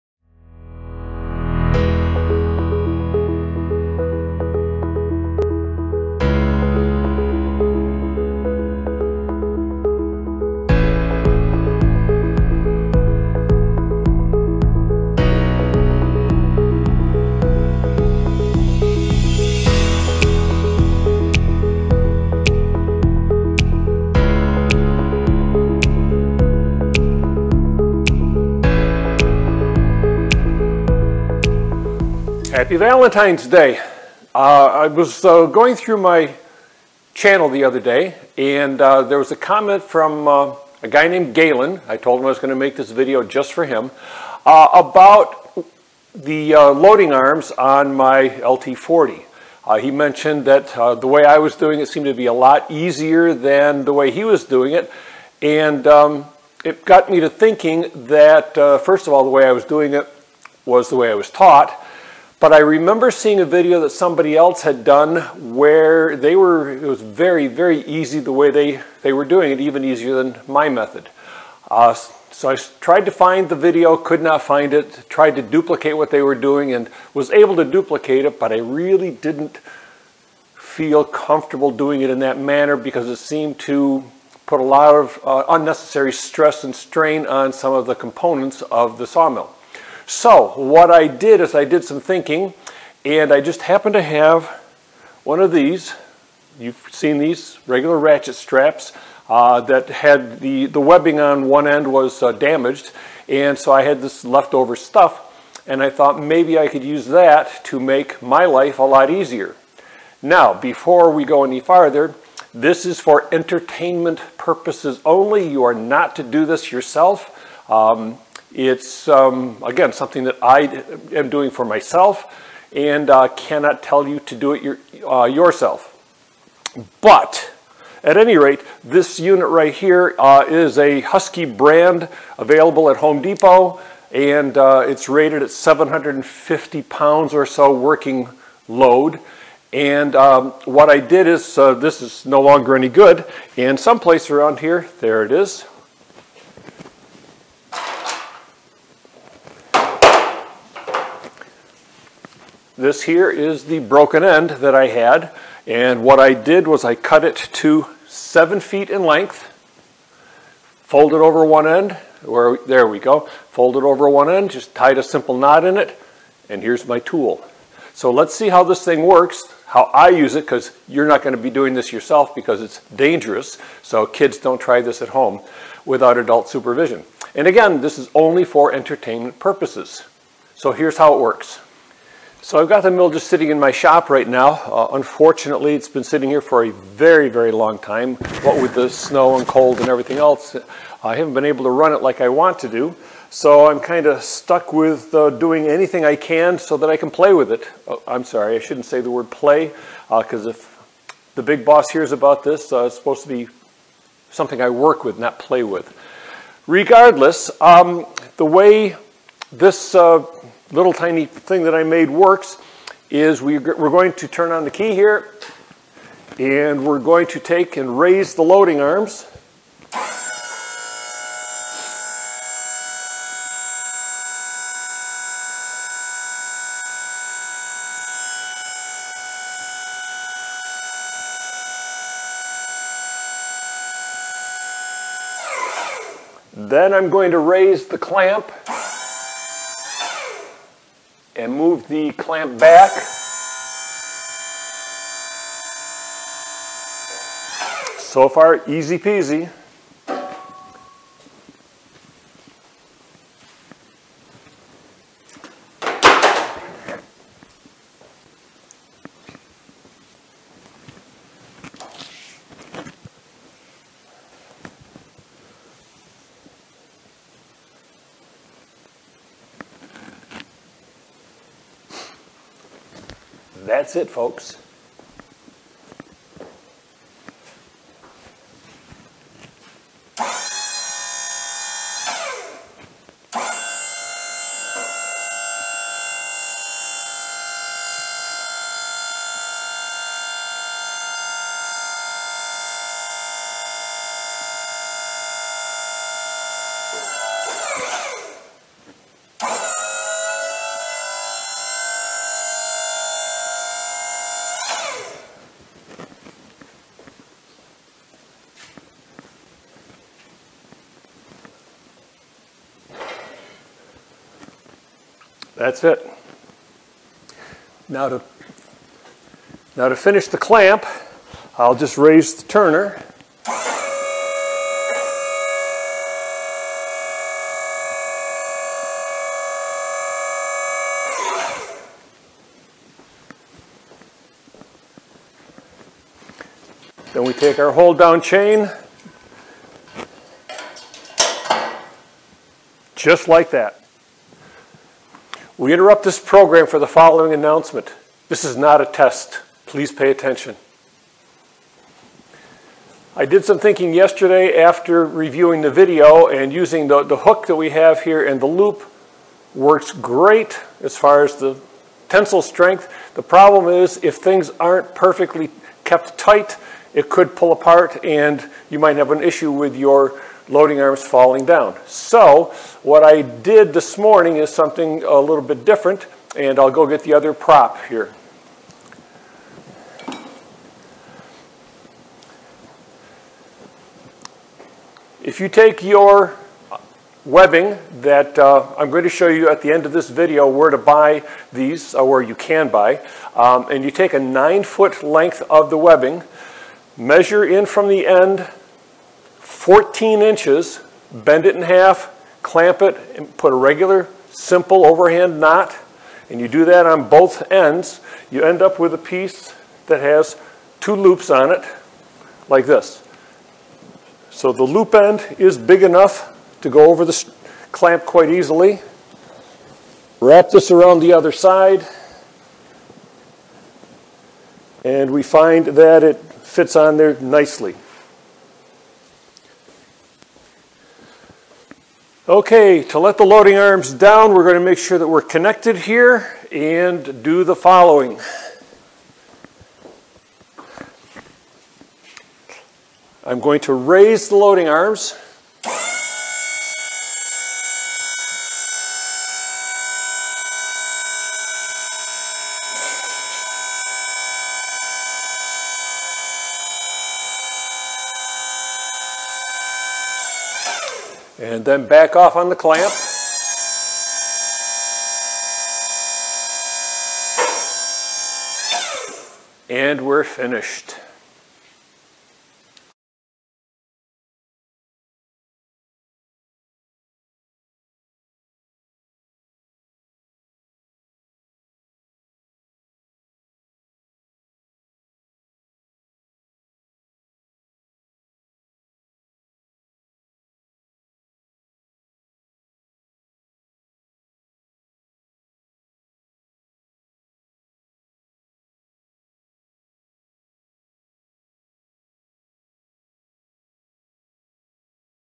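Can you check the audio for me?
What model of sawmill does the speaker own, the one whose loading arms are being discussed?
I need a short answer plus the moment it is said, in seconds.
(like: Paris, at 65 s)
LT40, at 48 s.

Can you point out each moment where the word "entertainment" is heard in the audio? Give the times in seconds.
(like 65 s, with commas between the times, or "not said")
113 s, 178 s.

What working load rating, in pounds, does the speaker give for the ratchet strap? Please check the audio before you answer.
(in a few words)
750 pounds.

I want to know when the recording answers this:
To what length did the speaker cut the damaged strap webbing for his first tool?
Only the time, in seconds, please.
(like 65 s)
158 s.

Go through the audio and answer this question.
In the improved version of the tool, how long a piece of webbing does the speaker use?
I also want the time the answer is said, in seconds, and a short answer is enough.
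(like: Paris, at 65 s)
9 feet, at 394 s.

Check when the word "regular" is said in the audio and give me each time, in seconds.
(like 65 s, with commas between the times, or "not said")
97 s, 403 s.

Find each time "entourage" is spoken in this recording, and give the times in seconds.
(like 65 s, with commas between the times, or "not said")
not said.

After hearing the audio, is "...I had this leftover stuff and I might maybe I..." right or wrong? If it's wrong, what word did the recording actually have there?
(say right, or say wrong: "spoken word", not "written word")
wrong: "thought", not "might".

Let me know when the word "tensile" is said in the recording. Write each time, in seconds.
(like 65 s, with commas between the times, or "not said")
362 s.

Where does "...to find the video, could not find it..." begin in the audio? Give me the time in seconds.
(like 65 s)
73 s.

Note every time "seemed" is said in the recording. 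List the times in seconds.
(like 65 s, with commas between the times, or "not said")
51 s, 83 s.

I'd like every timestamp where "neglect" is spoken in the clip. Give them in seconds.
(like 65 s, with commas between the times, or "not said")
not said.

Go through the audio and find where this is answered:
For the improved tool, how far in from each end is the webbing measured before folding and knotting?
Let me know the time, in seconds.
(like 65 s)
399 s.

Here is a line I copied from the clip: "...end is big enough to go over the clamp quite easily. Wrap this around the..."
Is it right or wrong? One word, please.
right.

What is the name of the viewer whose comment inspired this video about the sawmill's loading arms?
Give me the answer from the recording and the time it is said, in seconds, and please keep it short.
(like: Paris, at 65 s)
Galen, at 41 s.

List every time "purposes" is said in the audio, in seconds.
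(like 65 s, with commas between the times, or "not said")
114 s, 179 s.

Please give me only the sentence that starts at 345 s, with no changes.
We interrupt this program for the following announcement.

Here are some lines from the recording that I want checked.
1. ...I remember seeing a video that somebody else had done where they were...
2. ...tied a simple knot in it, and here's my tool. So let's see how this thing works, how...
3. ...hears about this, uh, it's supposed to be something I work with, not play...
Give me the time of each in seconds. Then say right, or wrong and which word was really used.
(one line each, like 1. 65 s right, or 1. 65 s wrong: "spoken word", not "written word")
1. 62 s right
2. 164 s right
3. 201 s right.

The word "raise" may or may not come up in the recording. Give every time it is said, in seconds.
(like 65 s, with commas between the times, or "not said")
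217 s, 237 s, 321 s, 443 s.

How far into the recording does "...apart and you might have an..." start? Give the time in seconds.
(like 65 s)
367 s.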